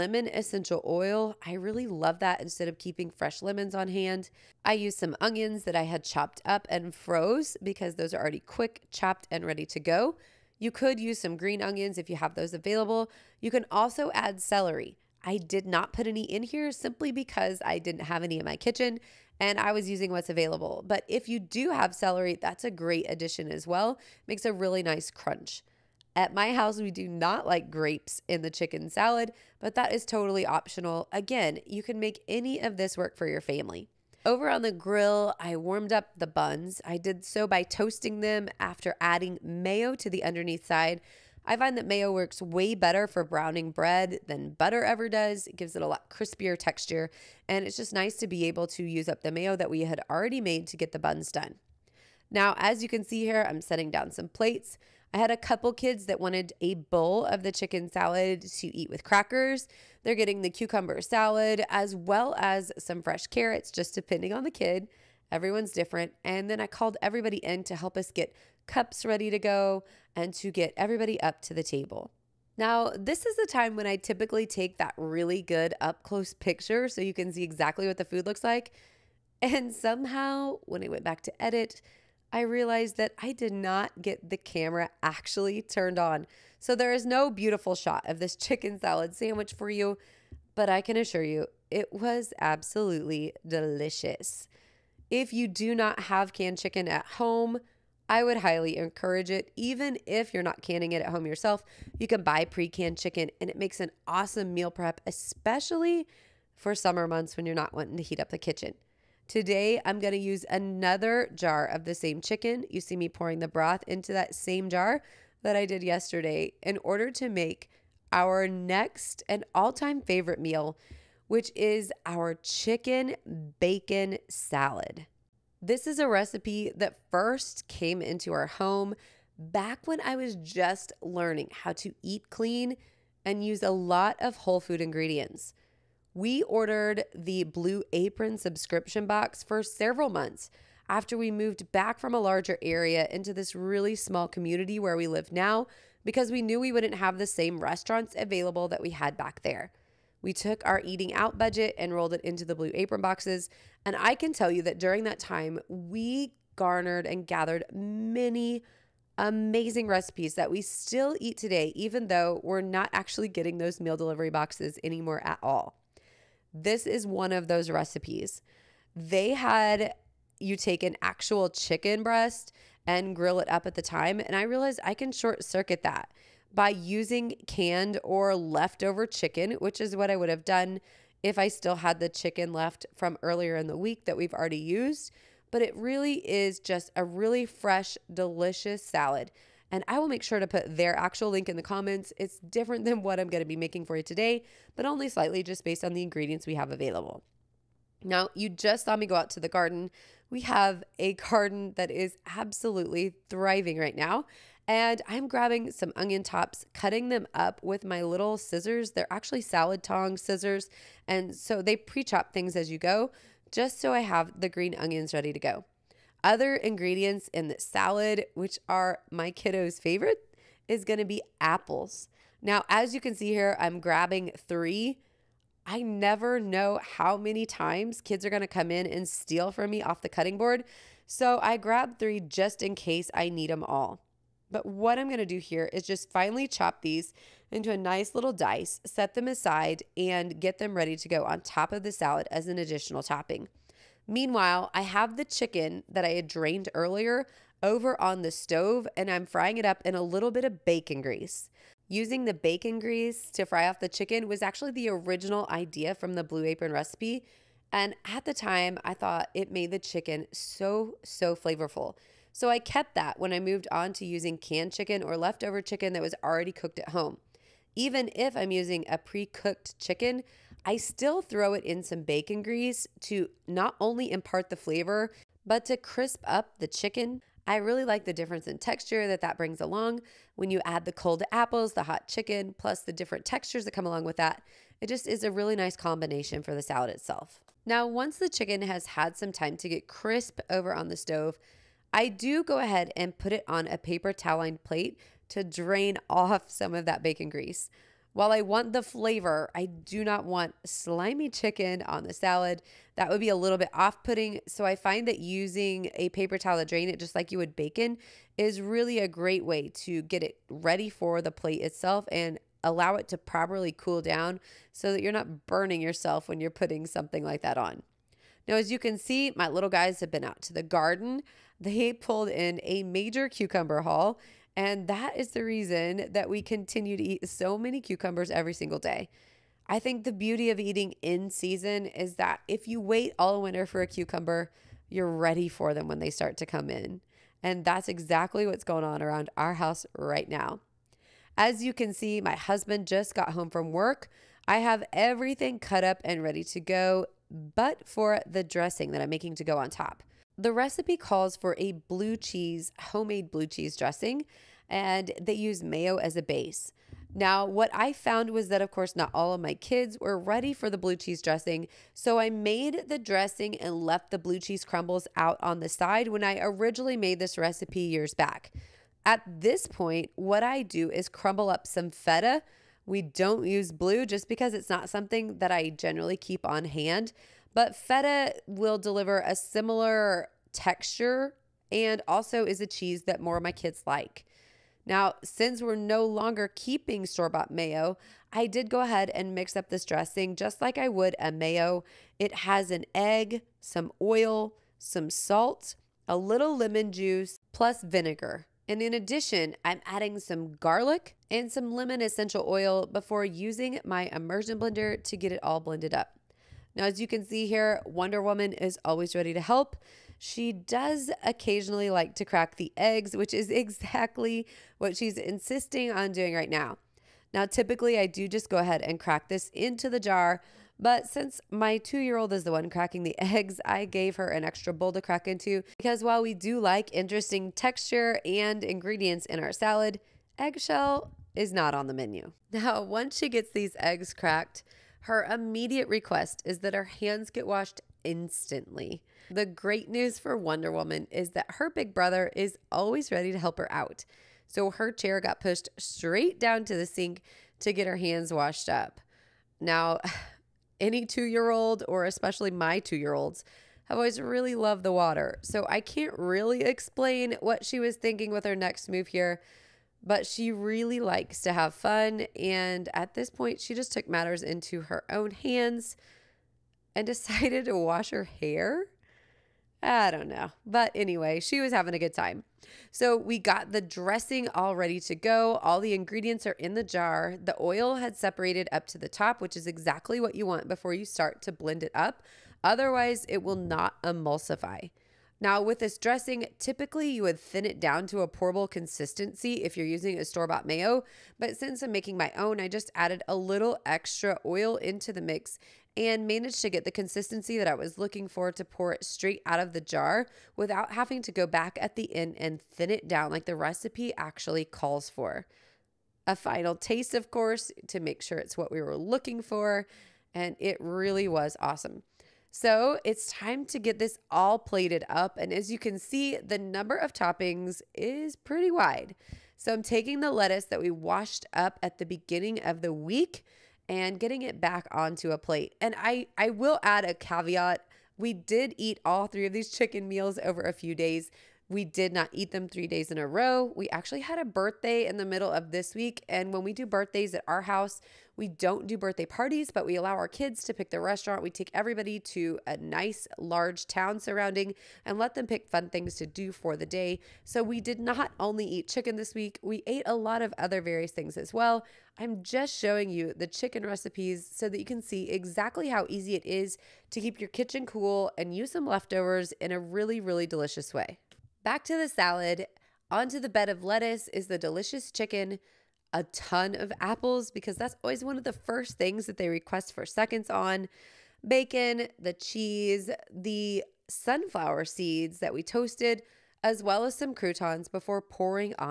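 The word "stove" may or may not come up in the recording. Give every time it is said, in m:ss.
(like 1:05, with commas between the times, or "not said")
4:08, 4:50.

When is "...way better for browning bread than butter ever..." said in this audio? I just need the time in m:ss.
0:42.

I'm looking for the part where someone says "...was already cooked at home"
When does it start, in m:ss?
4:26.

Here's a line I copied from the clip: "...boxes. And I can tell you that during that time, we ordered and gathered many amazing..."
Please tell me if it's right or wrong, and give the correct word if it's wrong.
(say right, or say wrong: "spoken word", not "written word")
wrong: "garnered", not "ordered".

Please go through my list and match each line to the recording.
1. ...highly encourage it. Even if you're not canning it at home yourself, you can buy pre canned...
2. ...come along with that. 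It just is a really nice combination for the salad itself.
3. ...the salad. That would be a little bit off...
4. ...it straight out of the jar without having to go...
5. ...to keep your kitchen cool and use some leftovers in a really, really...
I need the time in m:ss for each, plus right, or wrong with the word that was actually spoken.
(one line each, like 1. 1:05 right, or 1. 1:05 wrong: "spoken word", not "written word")
1. 1:38 right
2. 4:43 right
3. 5:02 right
4. 8:18 right
5. 9:17 right.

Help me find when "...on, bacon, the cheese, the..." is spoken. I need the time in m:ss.
9:30.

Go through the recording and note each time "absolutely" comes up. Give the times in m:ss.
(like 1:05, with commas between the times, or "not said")
1:32, 3:22.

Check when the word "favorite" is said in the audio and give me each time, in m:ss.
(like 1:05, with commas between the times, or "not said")
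2:00, 3:39.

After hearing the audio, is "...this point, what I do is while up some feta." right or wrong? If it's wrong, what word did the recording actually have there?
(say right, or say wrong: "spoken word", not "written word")
wrong: "crumble", not "while".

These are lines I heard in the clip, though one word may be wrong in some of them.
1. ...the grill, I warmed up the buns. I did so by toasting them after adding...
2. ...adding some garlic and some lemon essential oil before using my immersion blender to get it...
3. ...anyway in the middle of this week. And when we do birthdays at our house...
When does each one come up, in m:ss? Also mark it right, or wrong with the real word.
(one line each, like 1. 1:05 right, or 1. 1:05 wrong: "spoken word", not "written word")
1. 0:34 right
2. 6:39 right
3. 8:54 wrong: "birthday", not "anyway".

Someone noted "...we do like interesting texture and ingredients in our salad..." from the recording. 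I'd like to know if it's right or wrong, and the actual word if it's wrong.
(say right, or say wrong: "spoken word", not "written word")
right.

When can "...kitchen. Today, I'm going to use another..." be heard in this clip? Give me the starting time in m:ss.
1:48.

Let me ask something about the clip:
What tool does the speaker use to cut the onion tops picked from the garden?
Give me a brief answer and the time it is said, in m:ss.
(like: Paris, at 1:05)
Salad tong scissors, at 3:29.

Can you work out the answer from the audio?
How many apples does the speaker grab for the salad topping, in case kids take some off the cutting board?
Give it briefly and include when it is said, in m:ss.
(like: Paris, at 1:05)
3, at 3:43.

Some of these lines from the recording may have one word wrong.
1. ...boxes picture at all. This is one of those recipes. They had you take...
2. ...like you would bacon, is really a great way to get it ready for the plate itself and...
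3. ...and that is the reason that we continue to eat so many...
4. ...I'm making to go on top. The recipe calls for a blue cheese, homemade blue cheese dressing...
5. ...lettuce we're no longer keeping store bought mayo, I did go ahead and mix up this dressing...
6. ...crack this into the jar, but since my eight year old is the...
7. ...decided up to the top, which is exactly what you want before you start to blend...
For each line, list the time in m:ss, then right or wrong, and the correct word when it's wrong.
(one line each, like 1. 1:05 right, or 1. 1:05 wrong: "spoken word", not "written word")
1. 2:44 wrong: "anymore", not "picture"
2. 5:07 right
3. 5:24 right
4. 5:48 right
5. 6:25 wrong: "since", not "lettuce"
6. 6:58 wrong: "two", not "eight"
7. 7:58 wrong: "separated", not "decided".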